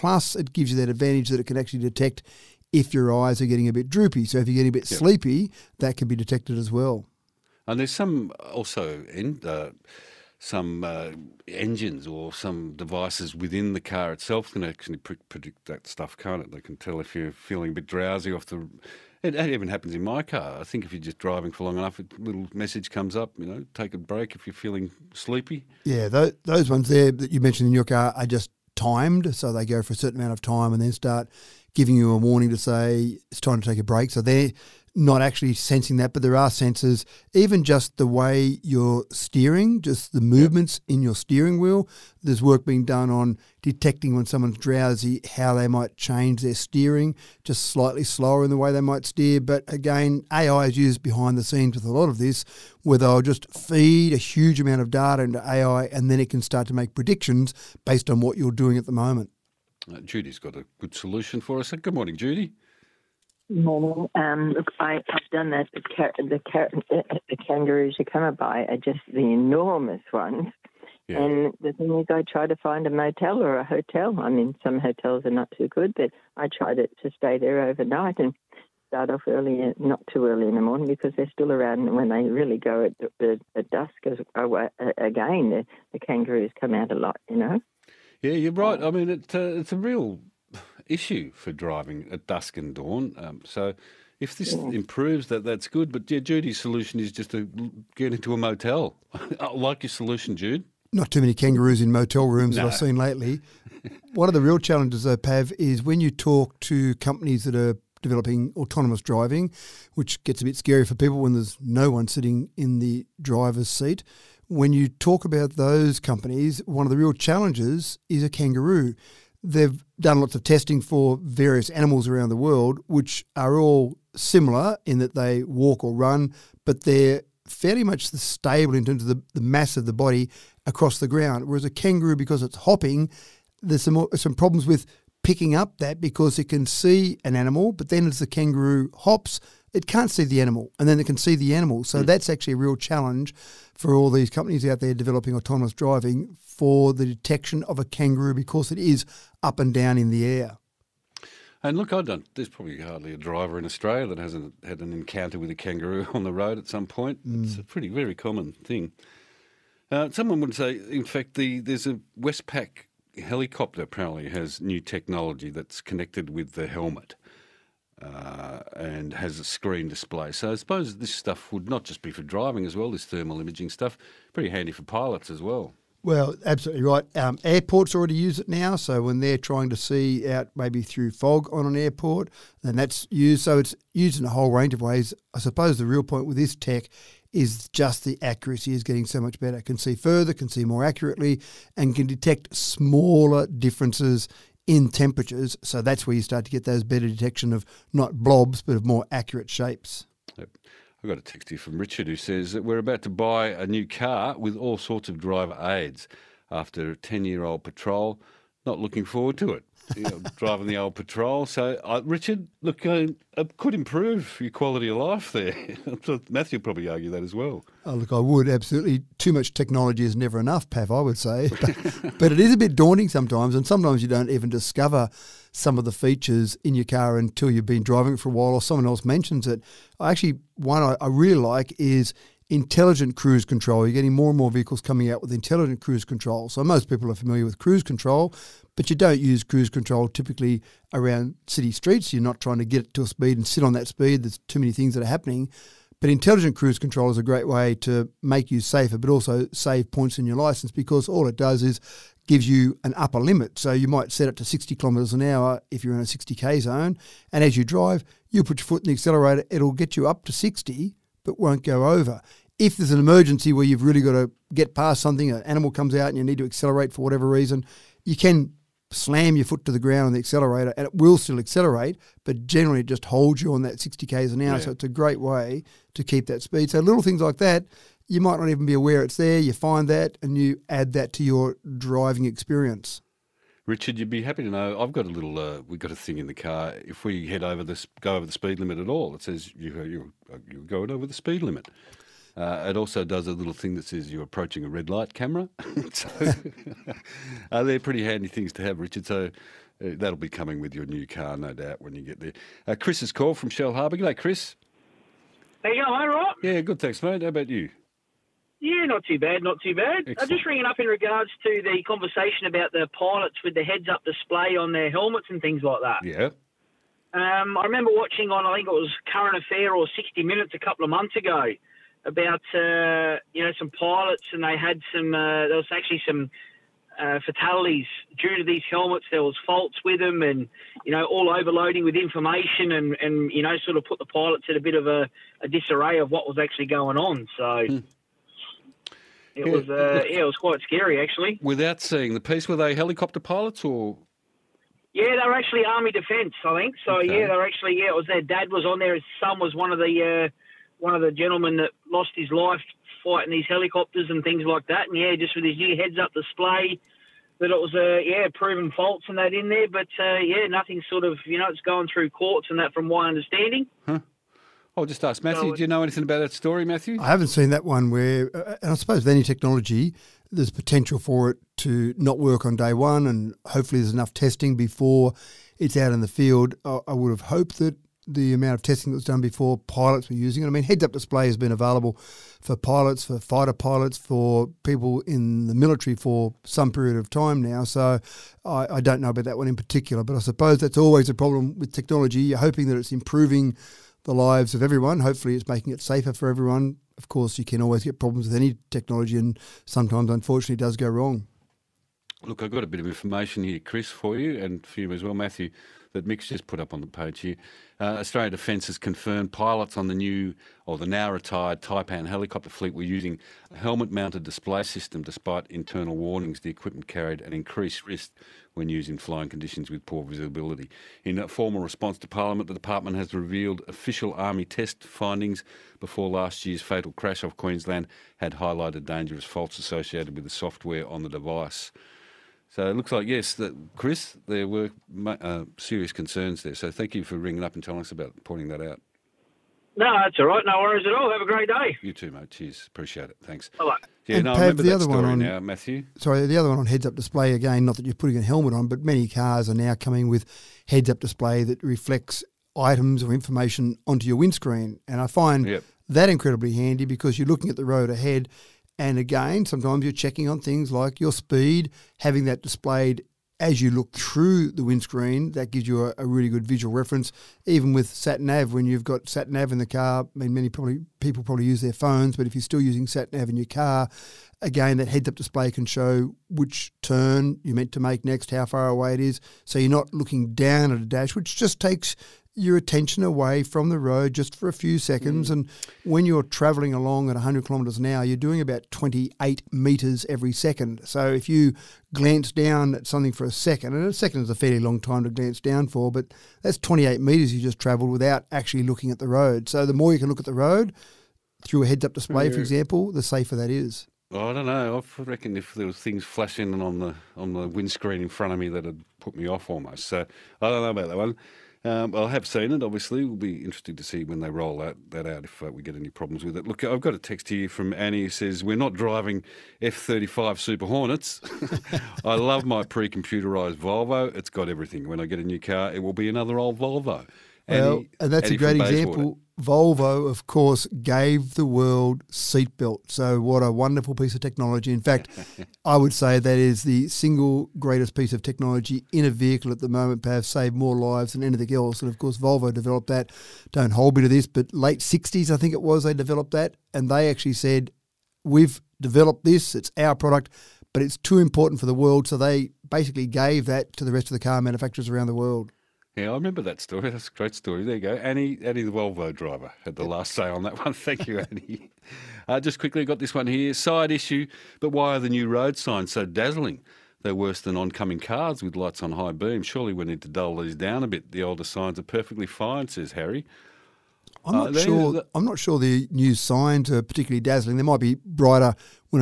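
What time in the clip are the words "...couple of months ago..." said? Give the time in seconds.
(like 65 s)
320 s.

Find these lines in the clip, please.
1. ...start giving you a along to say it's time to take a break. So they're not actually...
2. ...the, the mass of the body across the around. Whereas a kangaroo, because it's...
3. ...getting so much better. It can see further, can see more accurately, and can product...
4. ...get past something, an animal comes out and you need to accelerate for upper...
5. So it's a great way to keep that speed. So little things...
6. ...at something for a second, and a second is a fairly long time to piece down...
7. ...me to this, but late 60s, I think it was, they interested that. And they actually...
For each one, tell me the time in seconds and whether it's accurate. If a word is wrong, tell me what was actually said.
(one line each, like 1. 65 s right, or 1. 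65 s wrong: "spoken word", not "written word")
1. 30 s wrong: "warning", not "along"
2. 129 s wrong: "ground", not "around"
3. 188 s wrong: "detect", not "product"
4. 264 s wrong: "whatever", not "upper"
5. 274 s right
6. 492 s wrong: "glance", not "piece"
7. 543 s wrong: "developed", not "interested".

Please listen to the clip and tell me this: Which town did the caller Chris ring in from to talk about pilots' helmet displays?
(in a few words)
Shellharbour.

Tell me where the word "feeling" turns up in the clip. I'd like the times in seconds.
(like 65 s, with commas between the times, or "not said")
17 s, 24 s.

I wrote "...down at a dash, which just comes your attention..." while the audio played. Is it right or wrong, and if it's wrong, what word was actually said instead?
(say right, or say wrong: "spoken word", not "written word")
wrong: "takes", not "comes".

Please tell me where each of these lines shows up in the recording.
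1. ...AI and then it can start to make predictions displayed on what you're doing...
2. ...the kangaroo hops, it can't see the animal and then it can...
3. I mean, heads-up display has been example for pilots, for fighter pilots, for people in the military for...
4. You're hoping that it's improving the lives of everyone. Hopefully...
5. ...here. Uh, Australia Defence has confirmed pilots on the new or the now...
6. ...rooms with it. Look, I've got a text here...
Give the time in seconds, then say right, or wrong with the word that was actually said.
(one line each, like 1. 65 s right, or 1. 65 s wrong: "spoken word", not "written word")
1. 55 s wrong: "based", not "displayed"
2. 138 s right
3. 380 s wrong: "available", not "example"
4. 392 s right
5. 407 s right
6. 515 s wrong: "problems", not "rooms".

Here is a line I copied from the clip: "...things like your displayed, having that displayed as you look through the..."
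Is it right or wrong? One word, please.
wrong.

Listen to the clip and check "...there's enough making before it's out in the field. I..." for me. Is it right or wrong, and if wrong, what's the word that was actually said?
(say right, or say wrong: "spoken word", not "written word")
wrong: "testing", not "making".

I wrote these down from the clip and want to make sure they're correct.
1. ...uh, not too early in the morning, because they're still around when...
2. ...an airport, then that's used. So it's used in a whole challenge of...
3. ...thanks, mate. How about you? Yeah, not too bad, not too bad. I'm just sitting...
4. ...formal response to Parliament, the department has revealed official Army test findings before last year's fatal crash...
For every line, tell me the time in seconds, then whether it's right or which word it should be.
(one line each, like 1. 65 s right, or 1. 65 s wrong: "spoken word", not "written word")
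1. 79 s right
2. 181 s wrong: "range", not "challenge"
3. 306 s wrong: "ringing", not "sitting"
4. 421 s right.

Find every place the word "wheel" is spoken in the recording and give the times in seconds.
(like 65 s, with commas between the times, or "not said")
41 s.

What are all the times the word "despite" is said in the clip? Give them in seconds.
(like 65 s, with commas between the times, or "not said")
415 s.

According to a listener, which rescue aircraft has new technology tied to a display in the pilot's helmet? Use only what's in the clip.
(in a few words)
Westpac helicopter.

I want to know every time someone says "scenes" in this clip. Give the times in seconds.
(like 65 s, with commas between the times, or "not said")
51 s.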